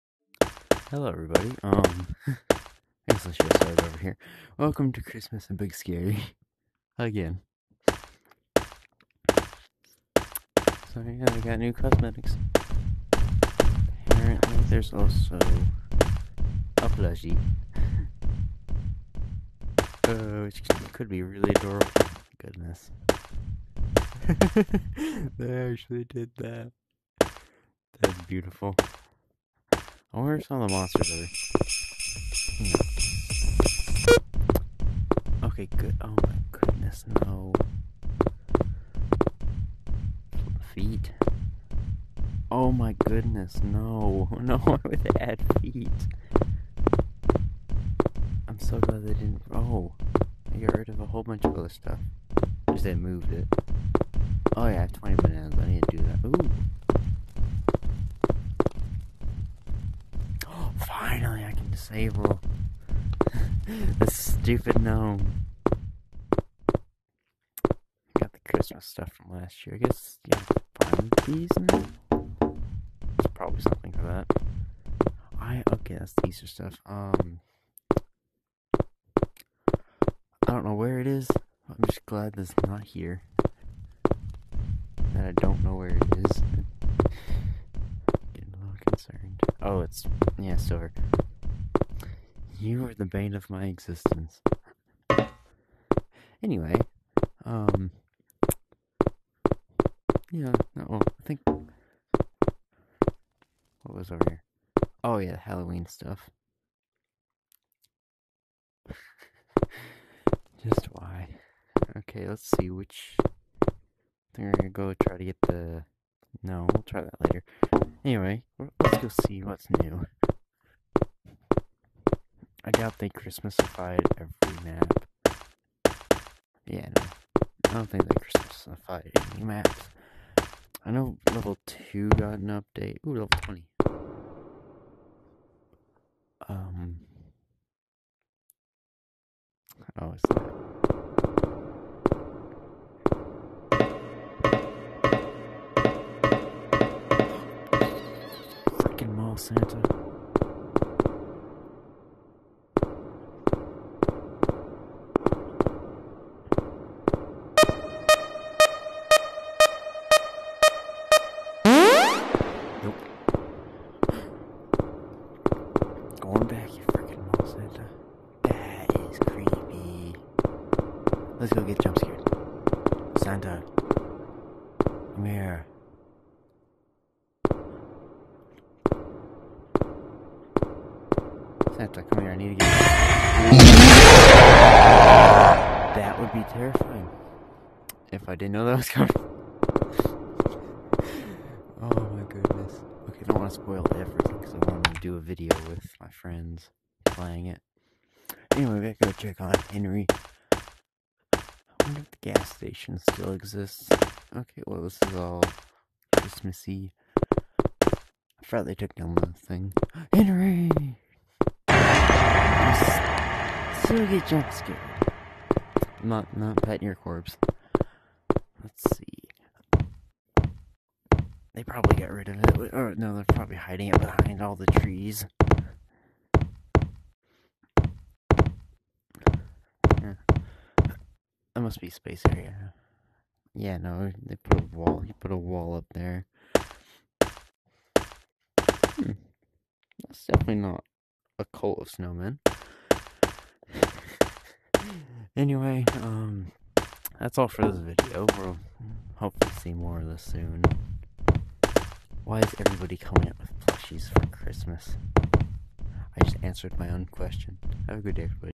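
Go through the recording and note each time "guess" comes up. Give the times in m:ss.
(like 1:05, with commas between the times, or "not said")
0:03, 1:09.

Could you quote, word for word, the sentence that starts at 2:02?
I doubt they Christmasified every map.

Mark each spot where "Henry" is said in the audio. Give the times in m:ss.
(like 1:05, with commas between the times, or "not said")
3:19, 3:30.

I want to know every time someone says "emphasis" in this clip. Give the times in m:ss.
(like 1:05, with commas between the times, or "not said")
not said.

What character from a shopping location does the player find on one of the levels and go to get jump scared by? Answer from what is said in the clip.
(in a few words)
Mall Santa.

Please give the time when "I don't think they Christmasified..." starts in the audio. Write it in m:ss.
2:07.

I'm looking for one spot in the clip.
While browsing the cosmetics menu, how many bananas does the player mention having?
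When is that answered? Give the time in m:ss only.
0:54.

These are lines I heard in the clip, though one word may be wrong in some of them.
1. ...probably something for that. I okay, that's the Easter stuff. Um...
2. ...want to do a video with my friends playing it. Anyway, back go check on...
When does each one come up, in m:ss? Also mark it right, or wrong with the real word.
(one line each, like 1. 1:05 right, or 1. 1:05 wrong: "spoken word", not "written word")
1. 1:13 right
2. 3:14 right.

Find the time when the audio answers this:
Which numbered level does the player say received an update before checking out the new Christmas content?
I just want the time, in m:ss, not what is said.
2:11.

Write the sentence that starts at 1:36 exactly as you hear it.
Anyway, um, yeah, no, well, I think, what was over here?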